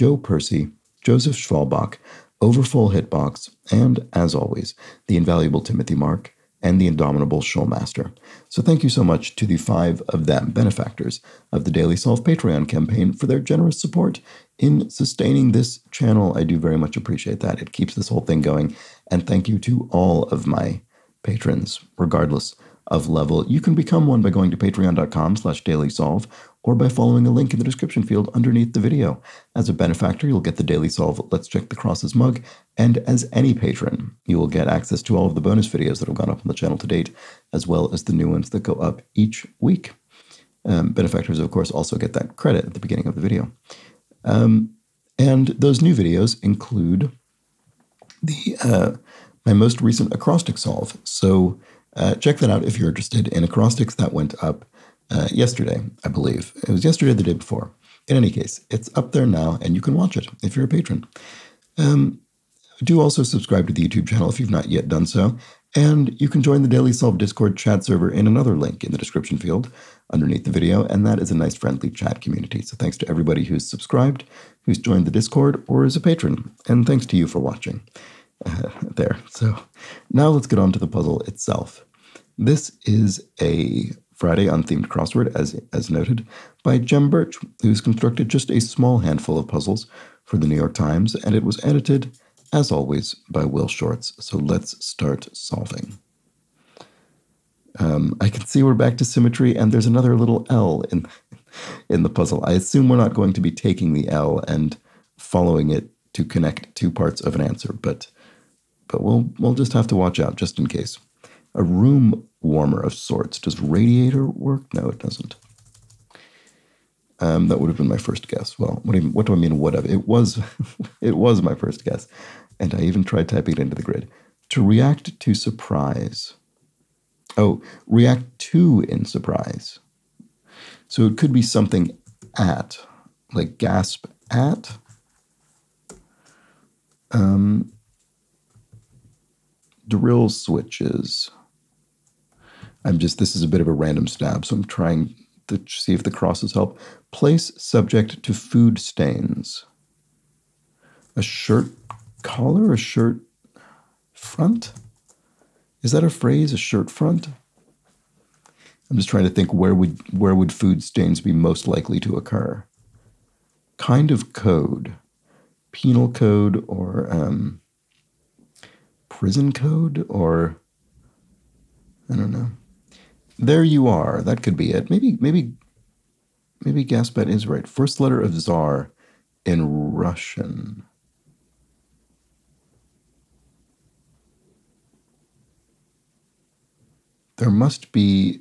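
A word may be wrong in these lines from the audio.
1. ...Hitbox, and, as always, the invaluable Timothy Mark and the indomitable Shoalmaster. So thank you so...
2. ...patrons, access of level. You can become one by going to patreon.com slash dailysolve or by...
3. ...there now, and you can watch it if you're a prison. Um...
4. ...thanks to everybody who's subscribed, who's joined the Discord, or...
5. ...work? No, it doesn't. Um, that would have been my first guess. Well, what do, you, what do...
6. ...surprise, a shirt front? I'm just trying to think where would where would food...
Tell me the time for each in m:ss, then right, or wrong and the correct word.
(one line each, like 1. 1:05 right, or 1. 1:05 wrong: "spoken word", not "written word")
1. 0:02 right
2. 0:21 wrong: "regardless", not "access"
3. 0:59 wrong: "patron", not "prison"
4. 1:12 right
5. 1:54 right
6. 2:36 wrong: "phrase", not "surprise".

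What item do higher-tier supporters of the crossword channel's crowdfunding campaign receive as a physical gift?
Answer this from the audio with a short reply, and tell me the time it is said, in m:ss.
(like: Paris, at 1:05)
Let's Check the Crosses mug, at 0:31.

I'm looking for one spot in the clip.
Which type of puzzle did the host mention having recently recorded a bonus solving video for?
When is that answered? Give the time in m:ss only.
0:50.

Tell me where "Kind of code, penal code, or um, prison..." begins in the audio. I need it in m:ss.
2:43.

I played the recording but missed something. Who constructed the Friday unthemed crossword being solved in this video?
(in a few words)
Jem Burch.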